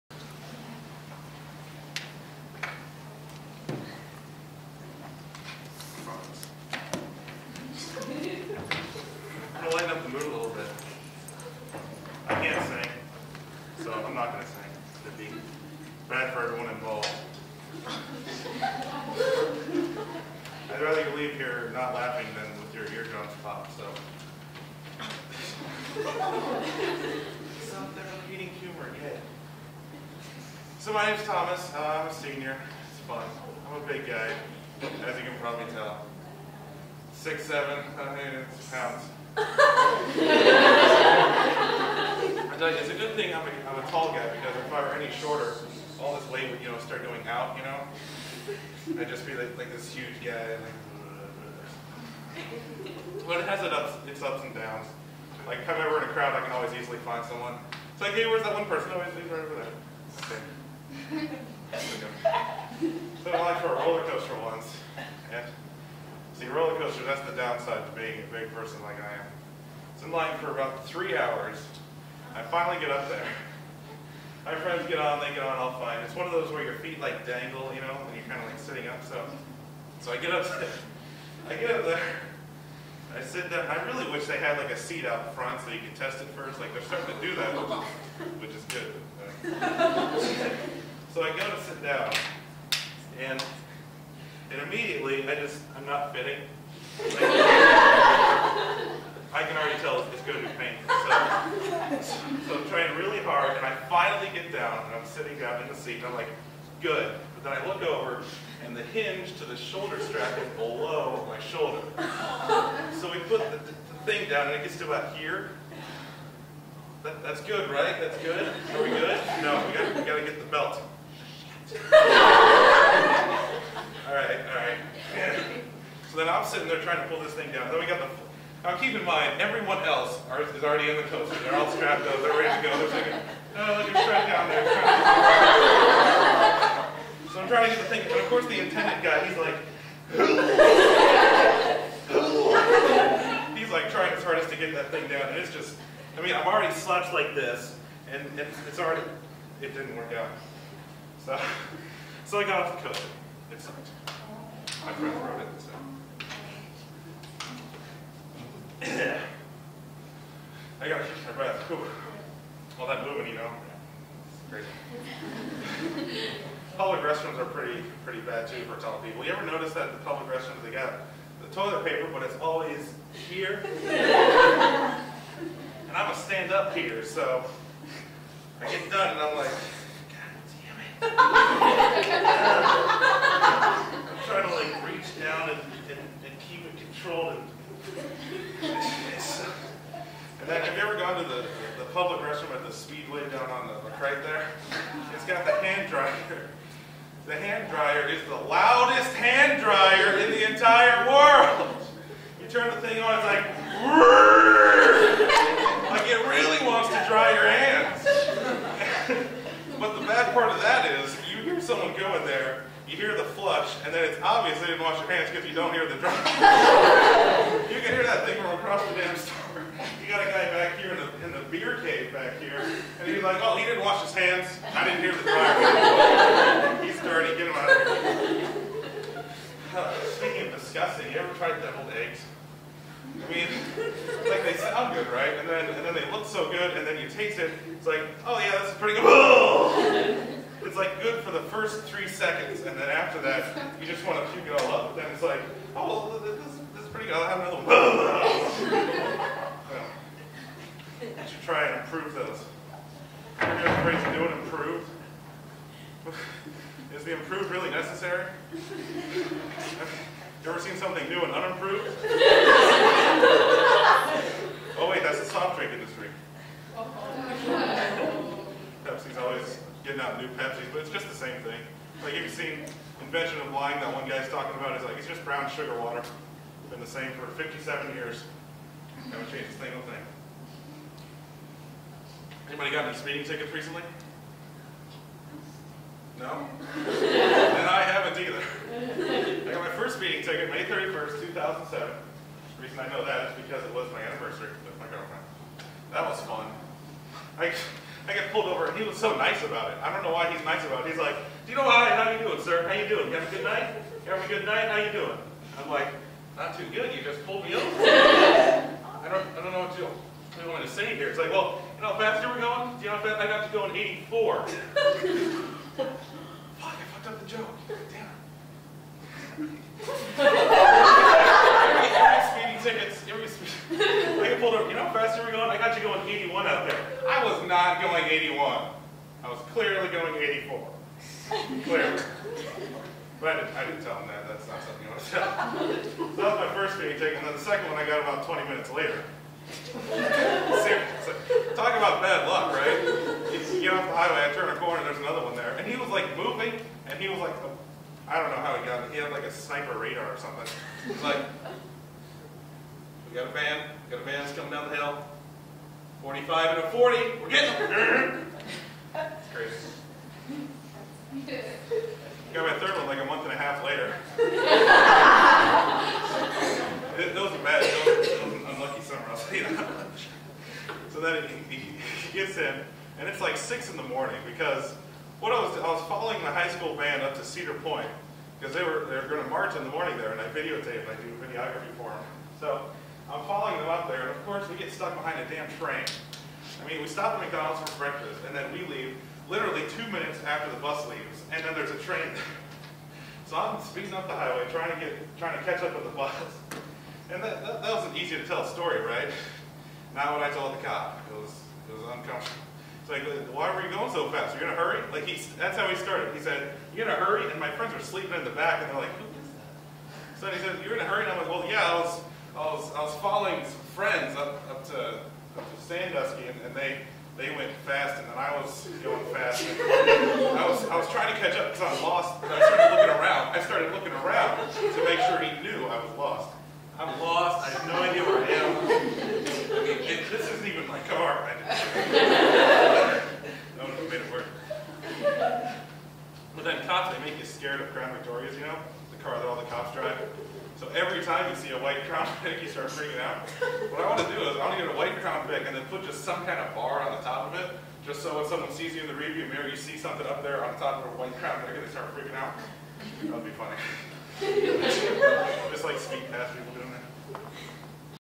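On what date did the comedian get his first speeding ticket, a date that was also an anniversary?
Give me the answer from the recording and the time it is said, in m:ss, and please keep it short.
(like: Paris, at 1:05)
May 31st, 2007, at 4:50.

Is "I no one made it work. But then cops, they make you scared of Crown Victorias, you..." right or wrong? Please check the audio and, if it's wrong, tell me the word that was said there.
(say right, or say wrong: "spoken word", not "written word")
right.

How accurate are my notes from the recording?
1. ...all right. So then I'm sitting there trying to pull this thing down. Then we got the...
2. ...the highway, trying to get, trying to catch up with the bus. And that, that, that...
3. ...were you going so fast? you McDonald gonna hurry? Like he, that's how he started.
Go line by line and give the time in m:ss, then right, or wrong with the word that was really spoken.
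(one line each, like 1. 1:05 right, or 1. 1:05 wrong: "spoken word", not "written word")
1. 2:04 right
2. 6:34 right
3. 6:43 wrong: "Are", not "McDonald".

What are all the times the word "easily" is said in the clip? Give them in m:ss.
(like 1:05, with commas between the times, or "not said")
0:56.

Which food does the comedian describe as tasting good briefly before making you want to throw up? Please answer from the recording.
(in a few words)
Deviled eggs.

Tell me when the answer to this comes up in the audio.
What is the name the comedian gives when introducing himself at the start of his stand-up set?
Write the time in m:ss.
0:31.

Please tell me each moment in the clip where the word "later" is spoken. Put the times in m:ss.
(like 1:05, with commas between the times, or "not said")
5:38, 6:03.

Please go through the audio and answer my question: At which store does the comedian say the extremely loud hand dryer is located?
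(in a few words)
Speedway.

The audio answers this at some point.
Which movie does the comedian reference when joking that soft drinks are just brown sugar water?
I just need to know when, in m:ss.
4:33.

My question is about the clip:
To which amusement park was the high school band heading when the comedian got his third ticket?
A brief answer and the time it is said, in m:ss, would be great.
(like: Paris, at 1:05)
Cedar Point, at 6:17.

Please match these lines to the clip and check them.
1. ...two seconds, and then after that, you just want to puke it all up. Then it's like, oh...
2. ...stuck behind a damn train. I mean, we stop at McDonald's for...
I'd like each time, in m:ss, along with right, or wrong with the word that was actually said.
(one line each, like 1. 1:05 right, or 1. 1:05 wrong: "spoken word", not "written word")
1. 4:01 wrong: "three", not "two"
2. 6:24 right.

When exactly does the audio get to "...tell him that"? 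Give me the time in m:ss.
5:33.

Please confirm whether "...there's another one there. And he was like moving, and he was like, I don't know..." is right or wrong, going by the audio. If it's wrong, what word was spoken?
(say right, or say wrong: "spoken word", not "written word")
right.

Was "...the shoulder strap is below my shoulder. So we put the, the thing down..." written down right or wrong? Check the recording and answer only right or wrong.
right.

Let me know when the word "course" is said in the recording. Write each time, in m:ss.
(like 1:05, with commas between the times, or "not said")
2:18, 6:24.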